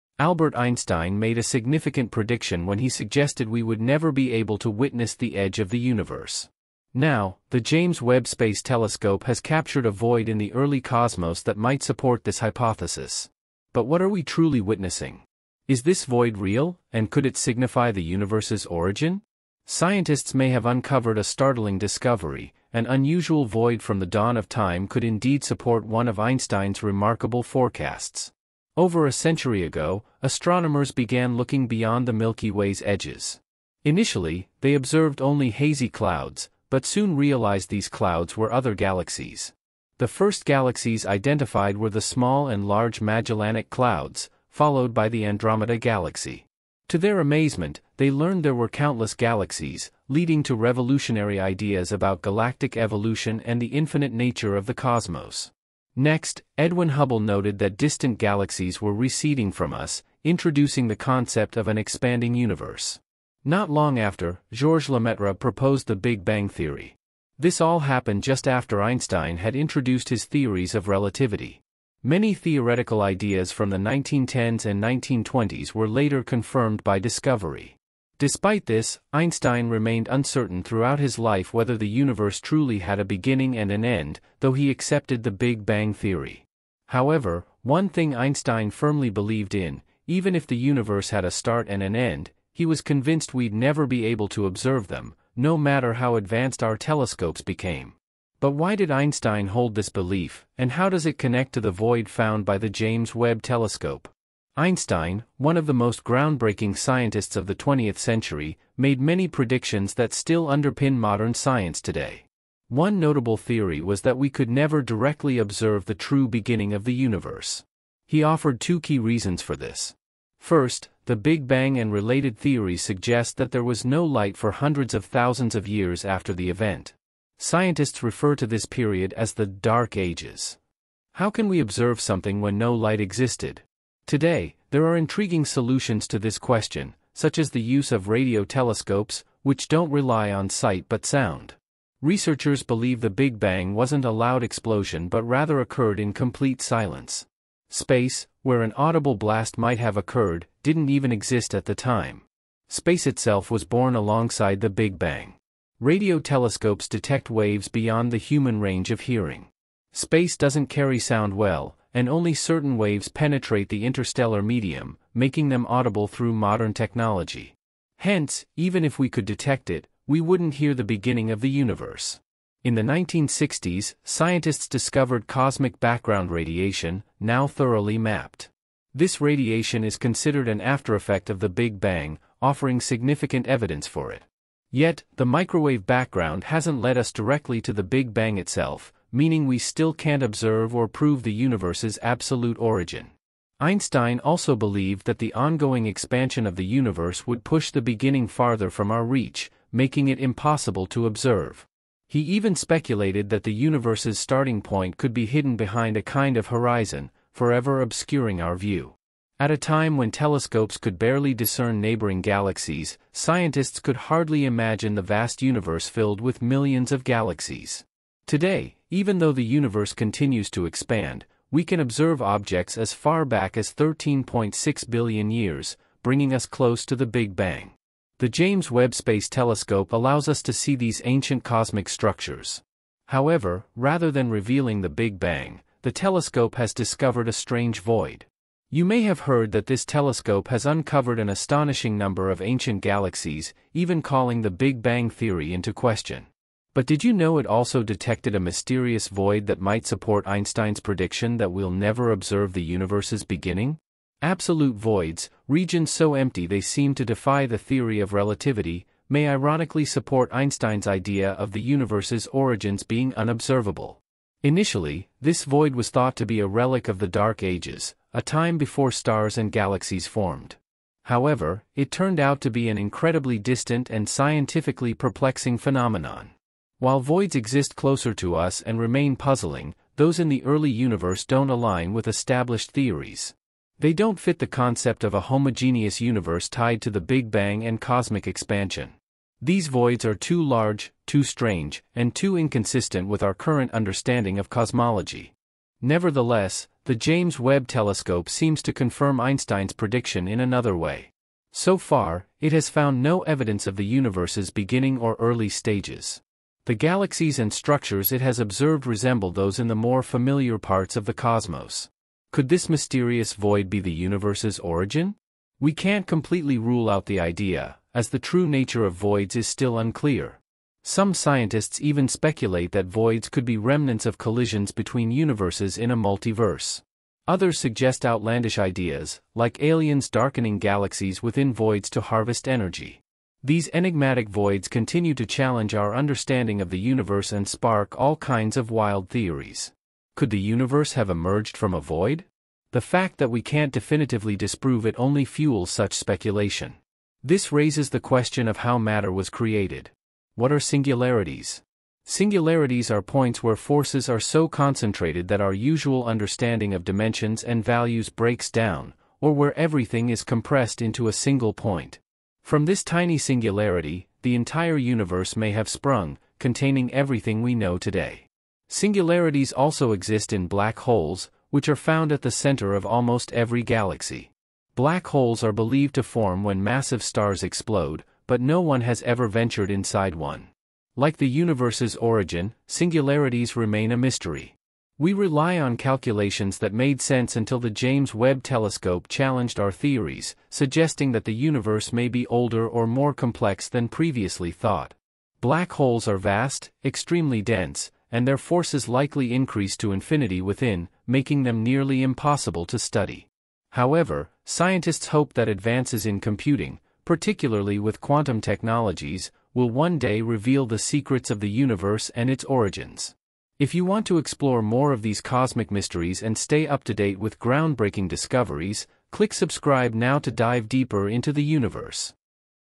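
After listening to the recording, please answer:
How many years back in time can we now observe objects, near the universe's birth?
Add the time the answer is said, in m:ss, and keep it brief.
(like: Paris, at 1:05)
13.6 billion years, at 3:43.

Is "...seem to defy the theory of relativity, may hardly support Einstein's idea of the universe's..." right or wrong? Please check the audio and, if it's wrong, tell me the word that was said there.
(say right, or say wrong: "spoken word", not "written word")
wrong: "ironically", not "hardly".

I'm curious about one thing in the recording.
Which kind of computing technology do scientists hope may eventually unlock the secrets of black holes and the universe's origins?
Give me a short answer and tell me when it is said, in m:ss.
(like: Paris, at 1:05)
quantum technologies, at 6:48.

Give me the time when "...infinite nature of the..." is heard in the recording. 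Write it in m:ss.
0:53.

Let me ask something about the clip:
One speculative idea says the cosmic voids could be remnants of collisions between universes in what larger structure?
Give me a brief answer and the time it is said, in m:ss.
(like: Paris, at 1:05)
a multiverse, at 5:25.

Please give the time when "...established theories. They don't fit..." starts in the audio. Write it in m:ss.
4:42.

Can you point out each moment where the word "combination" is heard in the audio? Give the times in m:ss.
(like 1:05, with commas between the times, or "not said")
not said.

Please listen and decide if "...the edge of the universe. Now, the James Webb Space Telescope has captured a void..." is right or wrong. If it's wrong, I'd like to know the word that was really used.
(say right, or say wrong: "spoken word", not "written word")
right.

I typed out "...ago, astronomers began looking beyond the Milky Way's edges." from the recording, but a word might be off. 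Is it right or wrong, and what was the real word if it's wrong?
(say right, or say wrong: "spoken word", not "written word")
right.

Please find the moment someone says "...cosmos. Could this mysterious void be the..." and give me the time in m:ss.
5:11.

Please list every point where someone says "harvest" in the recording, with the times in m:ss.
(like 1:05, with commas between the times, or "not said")
5:32.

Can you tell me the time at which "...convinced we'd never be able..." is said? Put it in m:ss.
1:32.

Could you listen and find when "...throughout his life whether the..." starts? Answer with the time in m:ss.
1:20.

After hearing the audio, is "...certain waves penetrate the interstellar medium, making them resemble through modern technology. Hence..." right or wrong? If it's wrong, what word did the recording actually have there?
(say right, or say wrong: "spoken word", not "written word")
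wrong: "audible", not "resemble".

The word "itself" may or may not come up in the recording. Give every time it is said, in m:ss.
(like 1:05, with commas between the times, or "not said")
2:33, 3:08.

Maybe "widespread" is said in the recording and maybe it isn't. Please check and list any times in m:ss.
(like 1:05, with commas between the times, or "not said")
not said.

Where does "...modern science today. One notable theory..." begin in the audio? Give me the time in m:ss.
1:50.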